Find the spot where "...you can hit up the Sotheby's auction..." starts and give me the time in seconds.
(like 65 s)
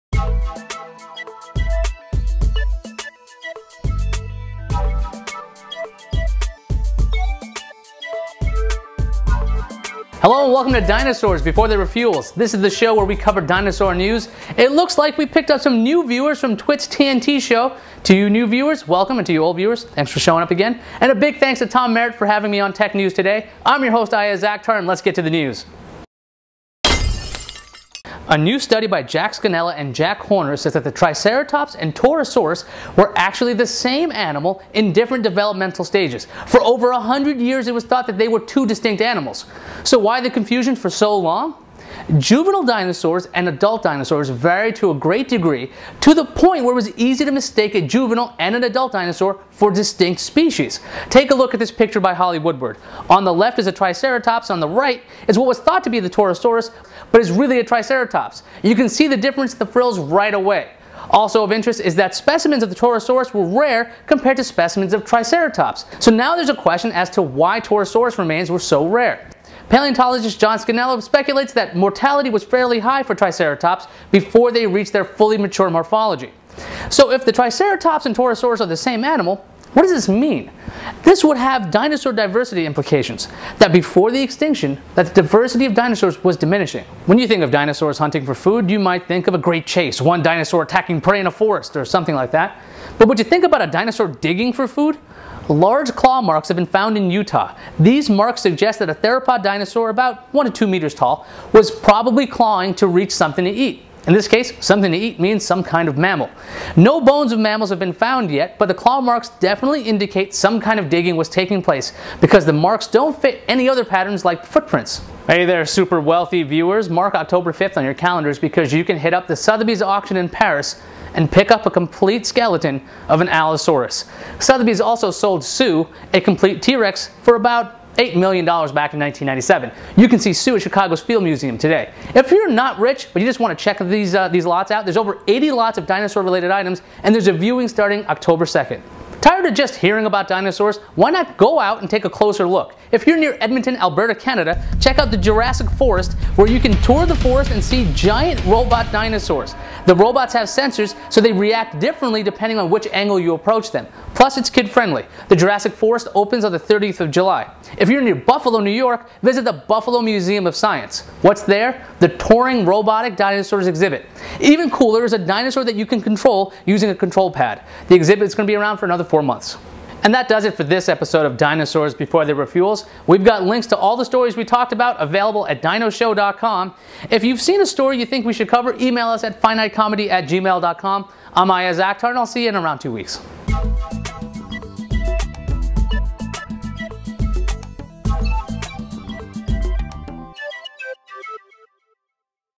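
118 s.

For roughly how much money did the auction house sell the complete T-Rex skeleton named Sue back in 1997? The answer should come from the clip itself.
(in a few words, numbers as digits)
$8 million.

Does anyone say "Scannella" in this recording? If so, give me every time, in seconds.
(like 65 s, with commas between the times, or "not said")
29 s, 70 s.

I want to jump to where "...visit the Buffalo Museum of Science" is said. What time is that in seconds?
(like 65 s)
159 s.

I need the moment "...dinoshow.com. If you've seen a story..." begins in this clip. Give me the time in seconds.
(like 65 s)
175 s.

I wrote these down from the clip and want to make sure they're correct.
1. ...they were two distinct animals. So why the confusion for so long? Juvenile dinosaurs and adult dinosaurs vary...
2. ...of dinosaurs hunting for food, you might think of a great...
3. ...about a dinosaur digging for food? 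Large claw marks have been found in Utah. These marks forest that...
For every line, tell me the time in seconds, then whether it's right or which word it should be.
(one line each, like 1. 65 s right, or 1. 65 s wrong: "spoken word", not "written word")
1. 38 s right
2. 87 s right
3. 93 s wrong: "suggest", not "forest".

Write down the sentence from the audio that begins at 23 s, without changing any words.
I'm your host, Ayaz Akhtar, and let's get to the news.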